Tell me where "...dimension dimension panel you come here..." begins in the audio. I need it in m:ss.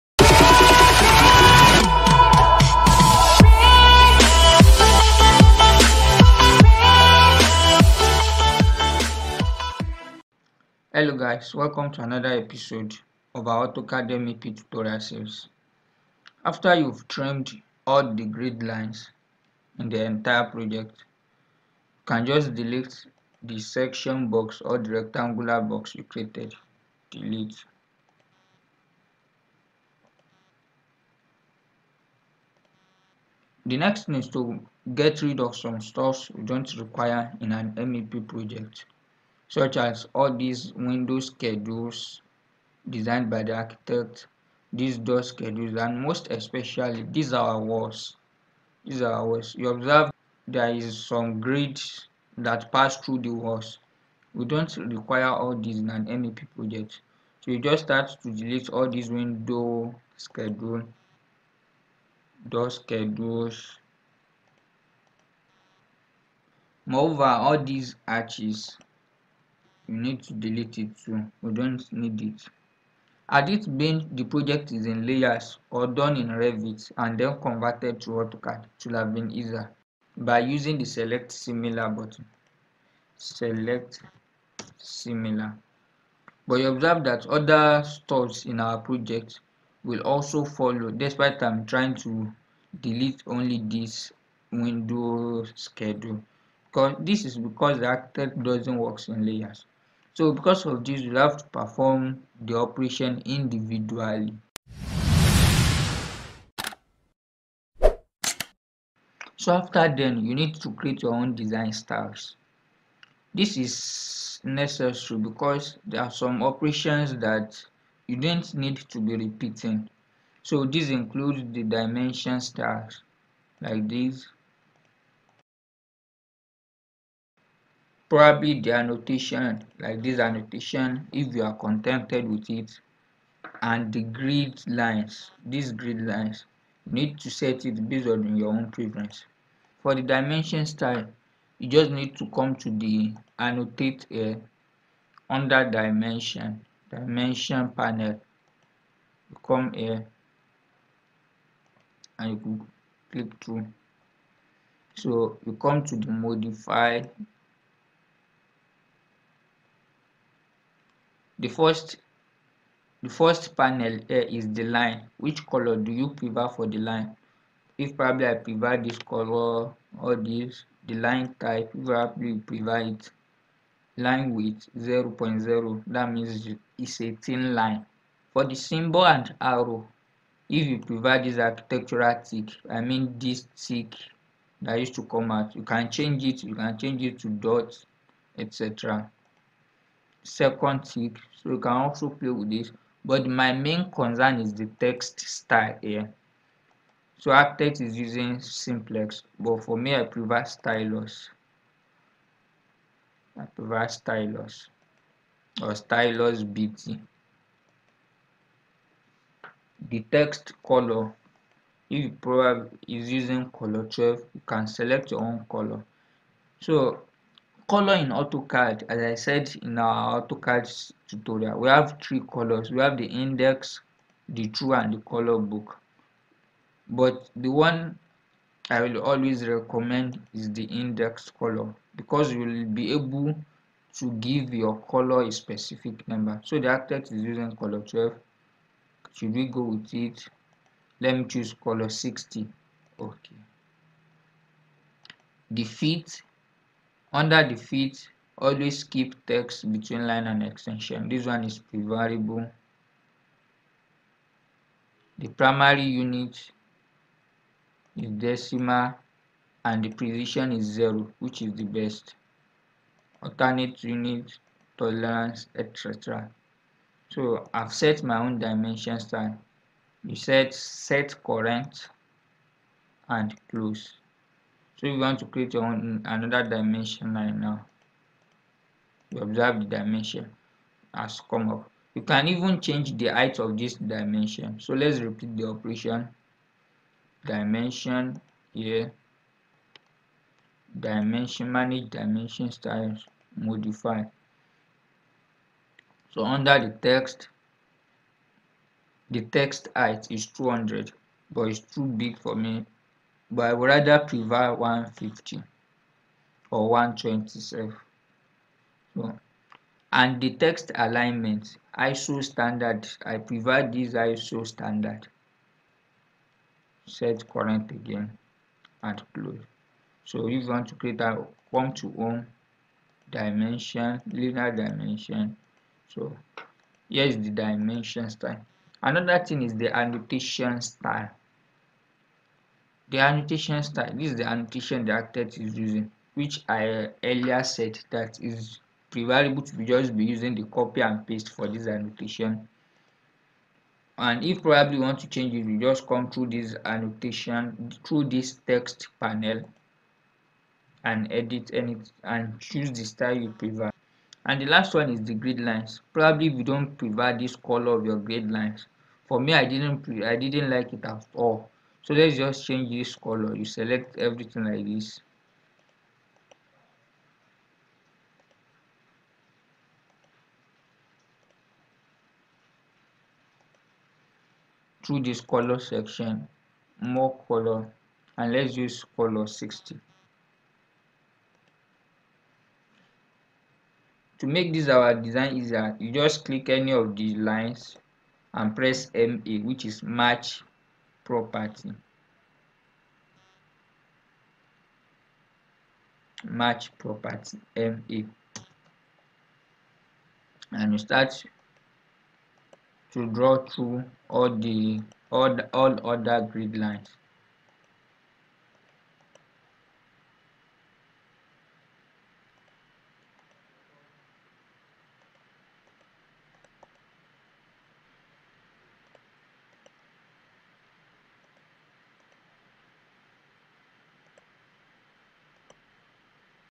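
2:25.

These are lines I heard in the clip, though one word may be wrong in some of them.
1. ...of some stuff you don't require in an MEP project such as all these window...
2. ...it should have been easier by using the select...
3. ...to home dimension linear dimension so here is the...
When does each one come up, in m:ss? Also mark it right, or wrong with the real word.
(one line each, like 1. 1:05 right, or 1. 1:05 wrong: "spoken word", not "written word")
1. 0:35 right
2. 1:18 right
3. 5:21 right.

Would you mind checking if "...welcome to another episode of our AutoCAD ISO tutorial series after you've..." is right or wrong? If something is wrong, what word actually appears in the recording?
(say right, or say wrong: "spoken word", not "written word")
wrong: "MEP", not "ISO".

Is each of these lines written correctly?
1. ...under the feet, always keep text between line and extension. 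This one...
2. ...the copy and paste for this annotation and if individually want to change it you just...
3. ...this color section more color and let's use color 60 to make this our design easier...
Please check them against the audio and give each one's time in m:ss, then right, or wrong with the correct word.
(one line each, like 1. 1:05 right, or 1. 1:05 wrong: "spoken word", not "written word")
1. 4:07 right
2. 5:40 wrong: "probably", not "individually"
3. 6:15 right.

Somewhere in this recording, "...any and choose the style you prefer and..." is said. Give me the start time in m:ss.
5:51.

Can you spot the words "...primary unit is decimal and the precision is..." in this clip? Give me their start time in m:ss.
4:15.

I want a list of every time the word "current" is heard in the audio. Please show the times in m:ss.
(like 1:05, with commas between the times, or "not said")
4:31, 5:17.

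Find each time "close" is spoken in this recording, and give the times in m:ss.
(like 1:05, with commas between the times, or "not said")
4:33, 5:19.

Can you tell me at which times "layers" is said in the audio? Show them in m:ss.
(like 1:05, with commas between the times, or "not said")
1:15, 1:39.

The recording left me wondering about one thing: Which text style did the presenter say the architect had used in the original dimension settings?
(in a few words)
Simplex.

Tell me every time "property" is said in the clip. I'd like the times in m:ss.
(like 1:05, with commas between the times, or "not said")
6:31, 6:36.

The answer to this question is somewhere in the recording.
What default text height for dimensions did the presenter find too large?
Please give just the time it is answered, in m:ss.
5:00.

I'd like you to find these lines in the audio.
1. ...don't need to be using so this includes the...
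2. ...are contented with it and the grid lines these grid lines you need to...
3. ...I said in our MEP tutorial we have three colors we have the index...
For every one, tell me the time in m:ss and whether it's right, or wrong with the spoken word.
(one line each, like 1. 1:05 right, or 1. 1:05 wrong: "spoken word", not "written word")
1. 1:58 wrong: "repeating", not "using"
2. 2:11 right
3. 3:39 wrong: "AutoCAD", not "MEP".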